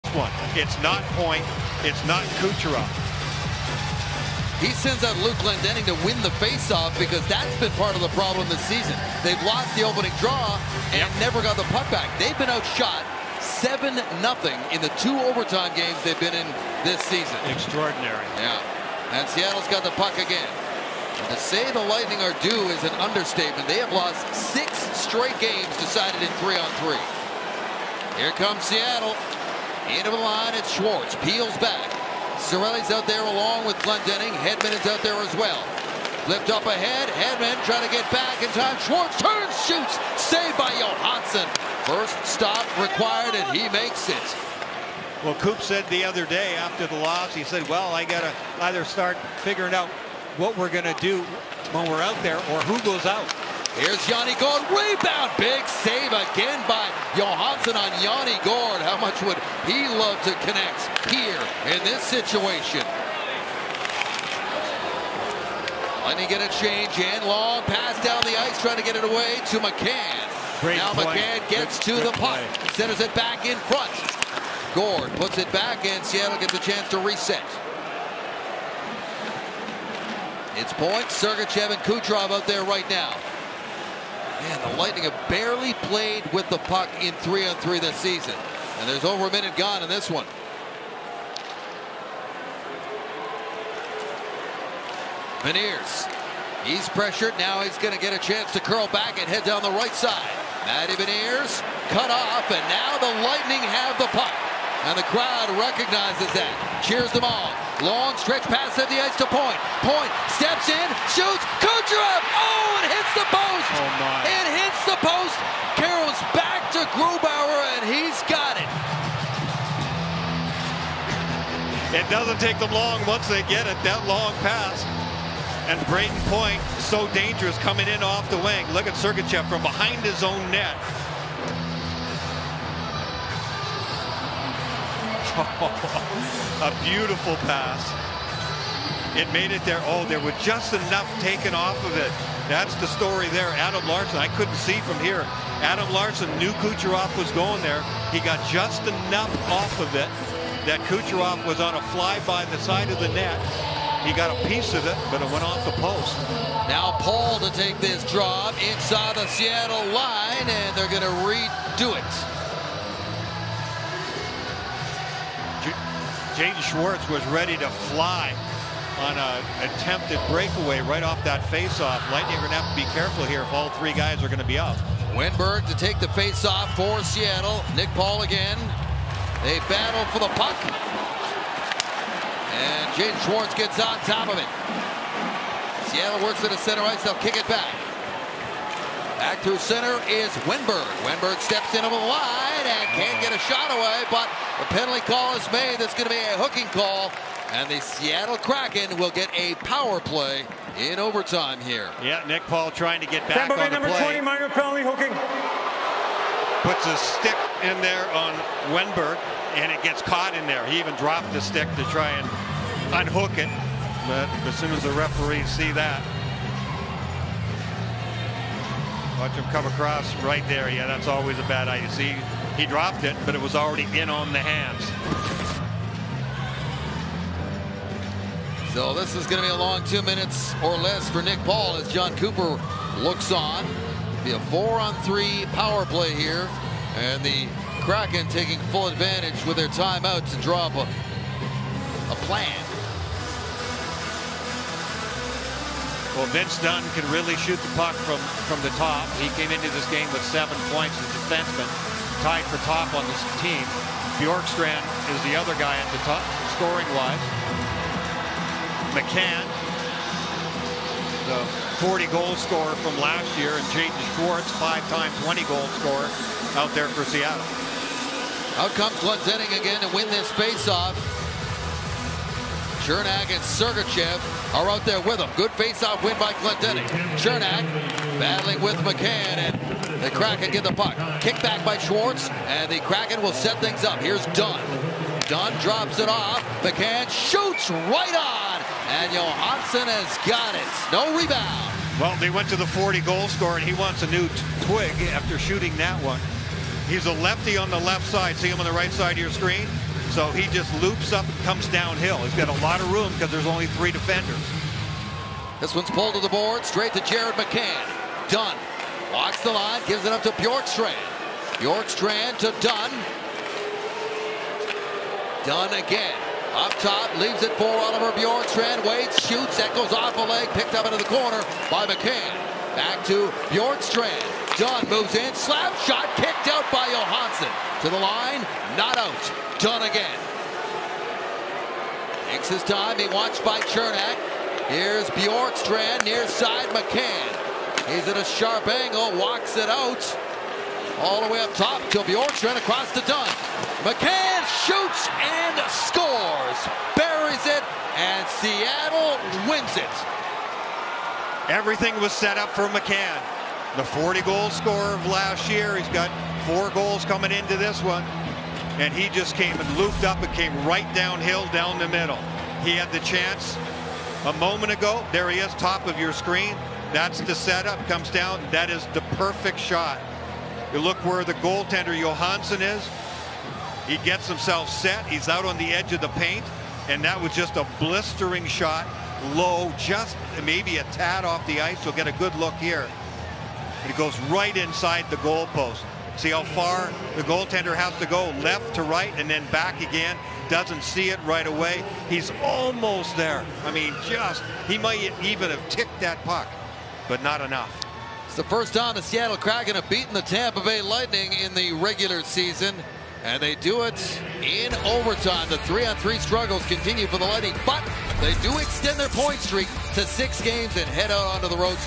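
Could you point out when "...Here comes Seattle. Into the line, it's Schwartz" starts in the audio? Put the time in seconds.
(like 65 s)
28 s.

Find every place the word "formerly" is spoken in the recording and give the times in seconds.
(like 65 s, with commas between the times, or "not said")
not said.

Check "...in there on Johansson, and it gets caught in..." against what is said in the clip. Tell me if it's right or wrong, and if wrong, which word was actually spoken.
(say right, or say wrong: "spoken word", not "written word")
wrong: "Wennberg", not "Johansson".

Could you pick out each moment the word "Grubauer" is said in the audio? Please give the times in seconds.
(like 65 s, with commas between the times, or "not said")
116 s.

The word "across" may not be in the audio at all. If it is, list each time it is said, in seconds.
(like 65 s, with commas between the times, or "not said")
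219 s, 342 s.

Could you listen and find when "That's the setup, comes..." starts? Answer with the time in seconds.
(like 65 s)
366 s.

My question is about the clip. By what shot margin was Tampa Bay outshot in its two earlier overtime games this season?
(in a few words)
7-0.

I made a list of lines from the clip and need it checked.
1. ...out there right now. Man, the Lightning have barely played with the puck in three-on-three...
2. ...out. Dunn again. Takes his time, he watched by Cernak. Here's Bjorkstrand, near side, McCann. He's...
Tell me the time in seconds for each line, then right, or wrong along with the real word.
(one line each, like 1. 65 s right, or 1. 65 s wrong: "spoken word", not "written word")
1. 82 s right
2. 328 s right.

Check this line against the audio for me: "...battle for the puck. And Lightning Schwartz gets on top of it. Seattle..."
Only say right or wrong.
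wrong.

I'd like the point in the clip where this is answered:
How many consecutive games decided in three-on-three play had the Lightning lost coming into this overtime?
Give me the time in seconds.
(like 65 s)
24 s.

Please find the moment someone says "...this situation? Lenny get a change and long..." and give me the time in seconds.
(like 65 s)
61 s.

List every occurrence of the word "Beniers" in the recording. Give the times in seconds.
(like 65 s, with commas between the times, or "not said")
95 s, 100 s.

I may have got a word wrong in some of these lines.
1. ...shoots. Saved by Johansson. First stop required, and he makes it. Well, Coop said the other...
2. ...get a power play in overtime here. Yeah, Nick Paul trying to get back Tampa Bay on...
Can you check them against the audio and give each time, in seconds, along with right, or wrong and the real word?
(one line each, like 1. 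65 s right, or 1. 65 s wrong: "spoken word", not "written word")
1. 39 s right
2. 199 s right.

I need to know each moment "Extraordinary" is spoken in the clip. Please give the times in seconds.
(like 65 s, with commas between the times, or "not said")
17 s.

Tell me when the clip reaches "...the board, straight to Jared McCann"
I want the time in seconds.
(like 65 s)
306 s.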